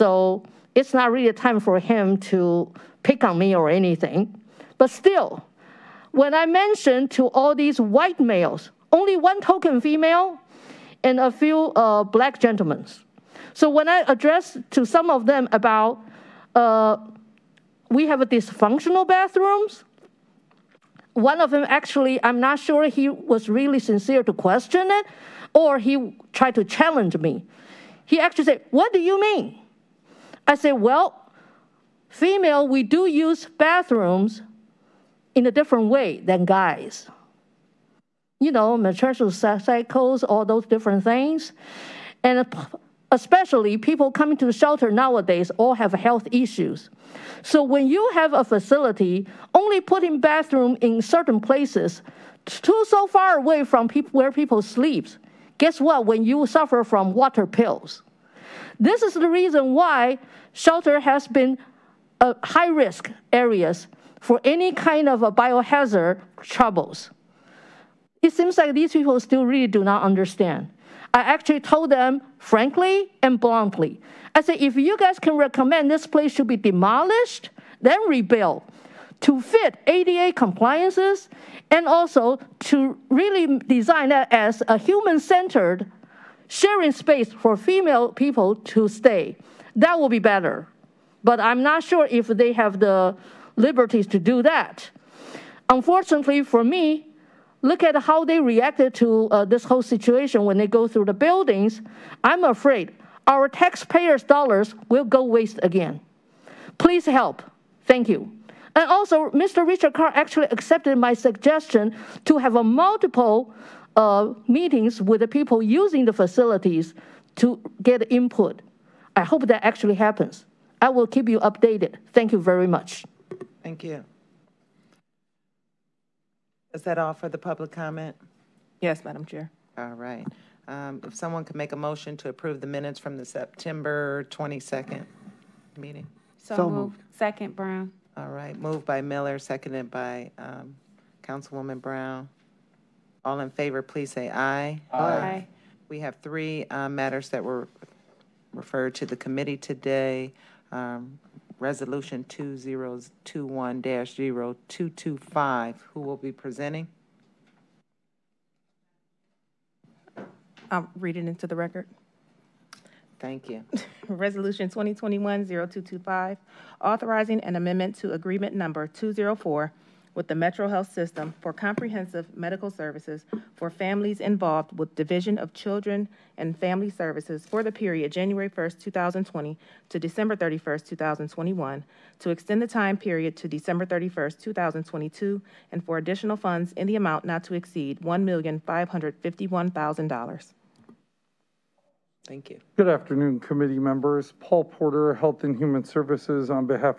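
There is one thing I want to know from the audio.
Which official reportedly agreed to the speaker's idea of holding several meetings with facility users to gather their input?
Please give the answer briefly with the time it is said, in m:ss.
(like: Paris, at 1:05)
Richard Carr, at 1:49.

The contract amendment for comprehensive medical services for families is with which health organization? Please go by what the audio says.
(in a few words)
Metro Health System.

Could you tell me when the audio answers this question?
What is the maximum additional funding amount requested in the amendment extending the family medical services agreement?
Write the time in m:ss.
3:08.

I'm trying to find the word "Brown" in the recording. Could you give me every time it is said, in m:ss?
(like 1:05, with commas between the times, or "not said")
2:17, 2:21.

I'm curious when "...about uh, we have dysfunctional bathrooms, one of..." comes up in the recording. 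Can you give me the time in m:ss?
0:15.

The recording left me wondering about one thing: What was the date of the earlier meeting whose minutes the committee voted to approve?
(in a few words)
September 22nd.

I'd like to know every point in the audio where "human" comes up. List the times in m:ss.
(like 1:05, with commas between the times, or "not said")
1:24, 3:15.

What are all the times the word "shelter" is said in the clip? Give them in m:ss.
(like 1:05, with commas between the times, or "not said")
0:44, 1:00.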